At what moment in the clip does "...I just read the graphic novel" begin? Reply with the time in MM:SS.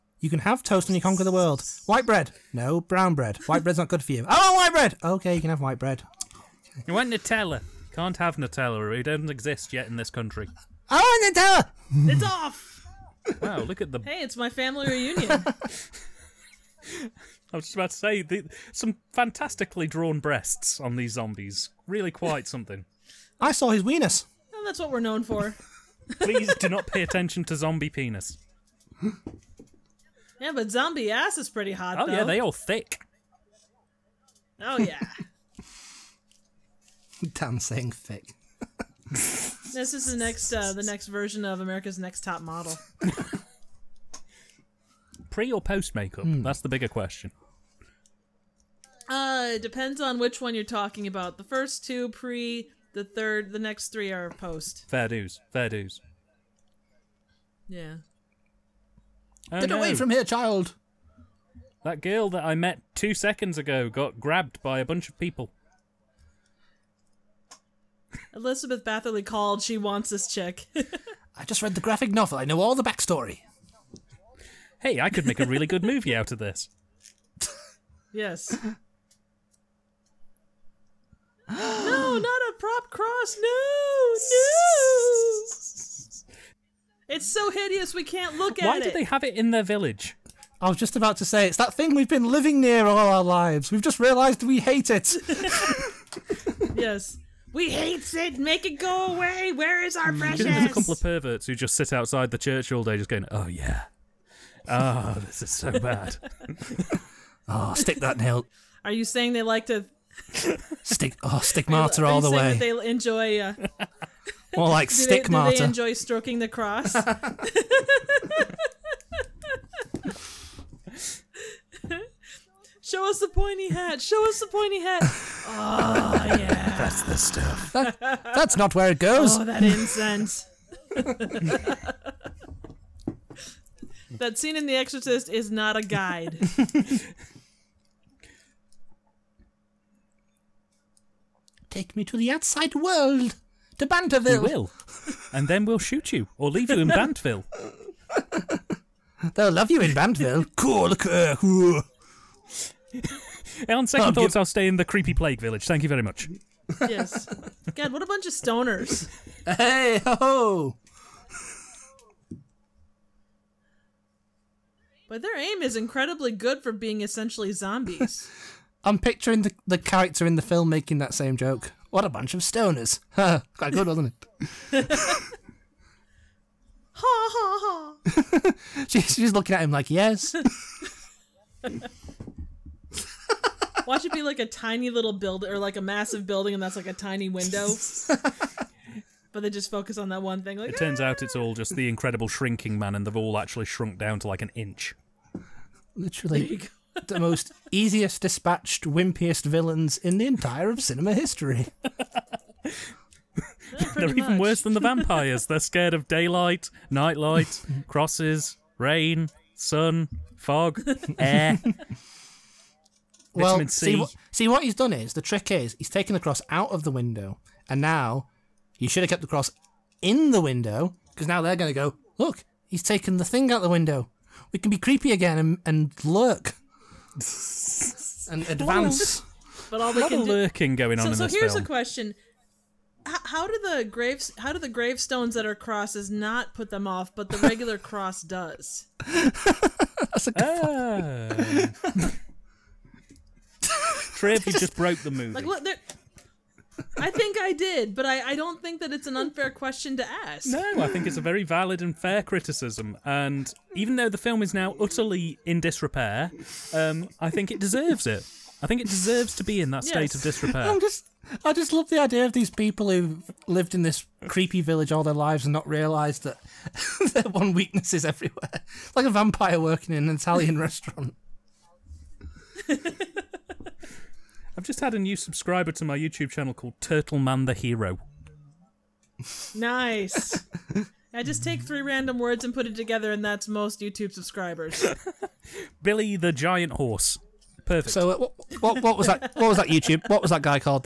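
01:11.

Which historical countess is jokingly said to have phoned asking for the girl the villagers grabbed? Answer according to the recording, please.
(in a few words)
Elizabeth Bathory.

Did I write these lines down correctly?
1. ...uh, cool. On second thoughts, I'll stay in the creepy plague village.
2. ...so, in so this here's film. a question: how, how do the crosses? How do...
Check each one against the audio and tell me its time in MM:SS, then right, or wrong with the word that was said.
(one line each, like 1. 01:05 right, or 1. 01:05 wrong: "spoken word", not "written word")
1. 02:30 right
2. 03:51 wrong: "graves", not "crosses".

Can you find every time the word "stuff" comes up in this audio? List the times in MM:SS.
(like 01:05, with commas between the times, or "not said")
02:07.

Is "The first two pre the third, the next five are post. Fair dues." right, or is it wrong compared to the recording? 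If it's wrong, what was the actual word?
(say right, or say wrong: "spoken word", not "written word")
wrong: "three", not "five".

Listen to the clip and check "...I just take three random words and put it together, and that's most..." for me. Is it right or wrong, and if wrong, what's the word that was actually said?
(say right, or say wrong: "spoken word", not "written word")
right.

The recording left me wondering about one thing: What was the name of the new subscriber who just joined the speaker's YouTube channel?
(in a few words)
Turtle Man the Hero.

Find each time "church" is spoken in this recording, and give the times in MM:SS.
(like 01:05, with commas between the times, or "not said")
01:42.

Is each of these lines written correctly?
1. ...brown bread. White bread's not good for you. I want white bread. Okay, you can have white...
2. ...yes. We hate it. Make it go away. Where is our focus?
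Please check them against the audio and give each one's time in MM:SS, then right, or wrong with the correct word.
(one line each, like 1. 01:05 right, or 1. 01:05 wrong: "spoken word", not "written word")
1. 00:02 right
2. 01:36 wrong: "precious", not "focus".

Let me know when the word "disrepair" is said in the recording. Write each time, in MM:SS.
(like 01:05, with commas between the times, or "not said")
04:15, 04:20.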